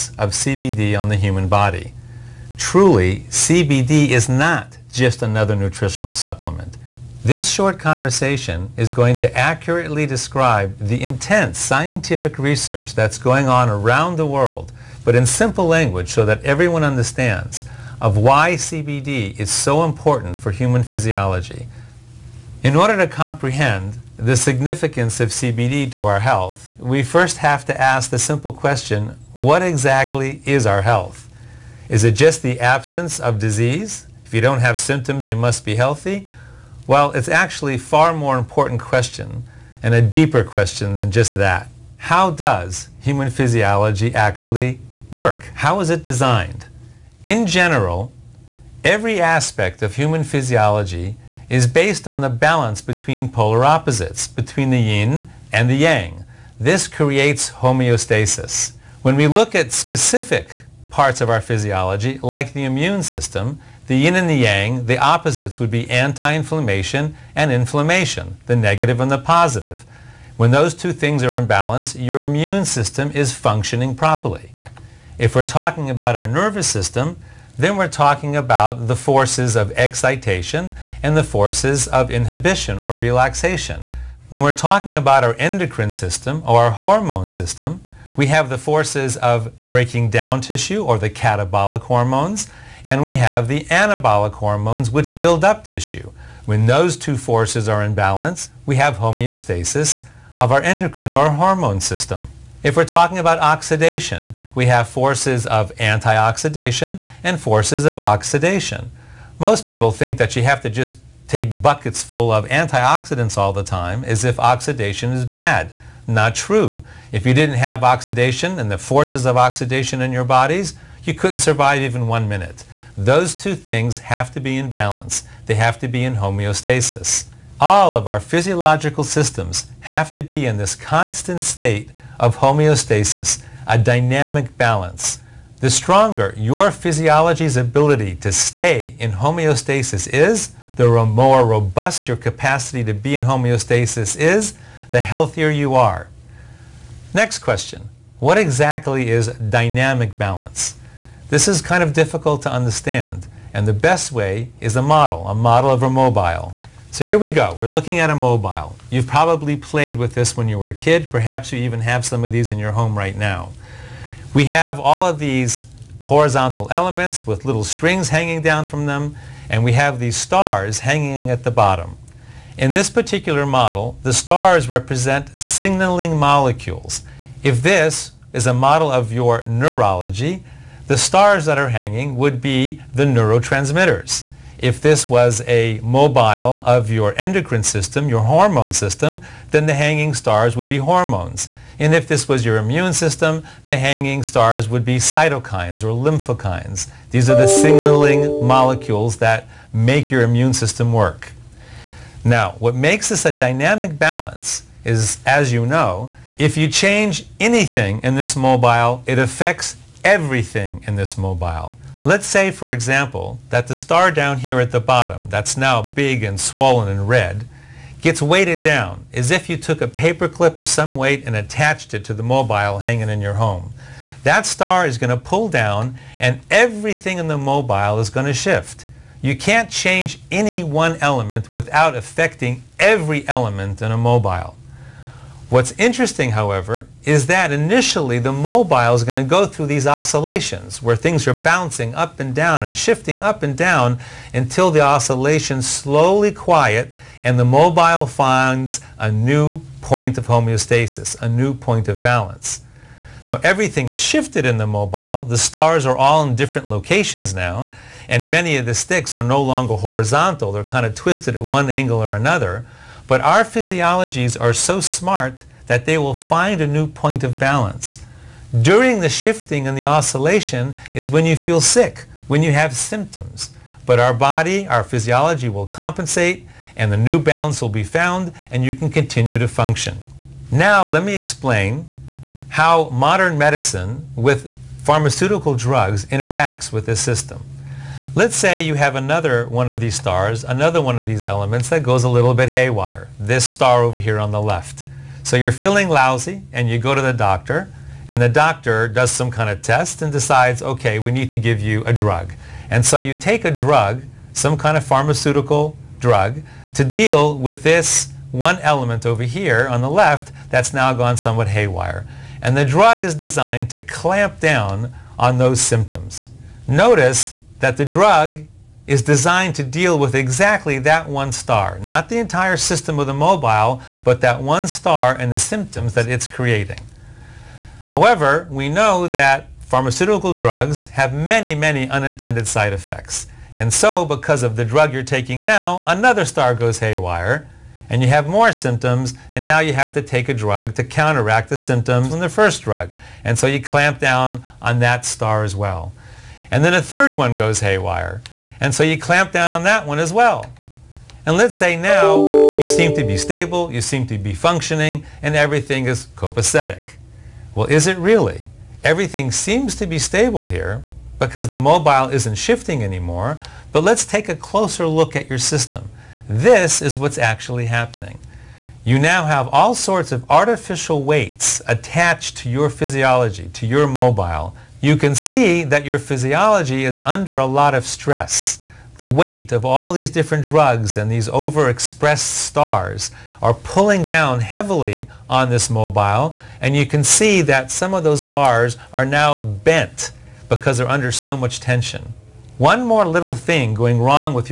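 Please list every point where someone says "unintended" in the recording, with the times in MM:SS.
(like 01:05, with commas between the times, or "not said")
05:31.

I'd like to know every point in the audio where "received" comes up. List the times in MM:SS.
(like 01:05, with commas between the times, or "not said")
not said.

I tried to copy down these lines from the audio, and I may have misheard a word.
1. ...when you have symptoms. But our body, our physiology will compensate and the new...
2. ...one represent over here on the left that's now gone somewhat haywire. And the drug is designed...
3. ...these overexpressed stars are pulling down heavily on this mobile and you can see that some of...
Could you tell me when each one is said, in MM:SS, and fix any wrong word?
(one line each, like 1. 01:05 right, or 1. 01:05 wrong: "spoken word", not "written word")
1. 04:32 right
2. 05:08 wrong: "element", not "represent"
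3. 06:21 right.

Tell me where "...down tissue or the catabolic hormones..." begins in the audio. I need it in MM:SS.
01:30.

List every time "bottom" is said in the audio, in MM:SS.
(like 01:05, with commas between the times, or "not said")
02:51, 03:34.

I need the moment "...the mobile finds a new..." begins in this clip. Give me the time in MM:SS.
04:07.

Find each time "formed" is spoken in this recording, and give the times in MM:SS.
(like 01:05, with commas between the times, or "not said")
not said.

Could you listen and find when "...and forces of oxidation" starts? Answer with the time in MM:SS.
01:47.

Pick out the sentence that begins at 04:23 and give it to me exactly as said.
But our physiologies are so smart that they will find a new point of balance.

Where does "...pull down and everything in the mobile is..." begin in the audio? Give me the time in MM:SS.
03:45.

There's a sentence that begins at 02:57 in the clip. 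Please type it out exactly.
If this is a model of your neurology, the stars that are hanging would be the neurotransmitters.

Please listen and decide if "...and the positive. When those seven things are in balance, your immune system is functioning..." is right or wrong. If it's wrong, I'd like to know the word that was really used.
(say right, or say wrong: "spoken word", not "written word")
wrong: "two", not "seven".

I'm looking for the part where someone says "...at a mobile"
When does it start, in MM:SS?
02:37.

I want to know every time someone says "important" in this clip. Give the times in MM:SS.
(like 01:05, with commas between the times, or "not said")
00:19, 00:38.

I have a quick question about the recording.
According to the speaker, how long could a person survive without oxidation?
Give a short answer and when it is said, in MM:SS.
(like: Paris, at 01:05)
one minute, at 02:02.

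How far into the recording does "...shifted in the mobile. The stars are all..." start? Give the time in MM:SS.
04:14.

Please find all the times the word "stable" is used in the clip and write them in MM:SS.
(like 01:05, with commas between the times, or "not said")
05:53, 05:59.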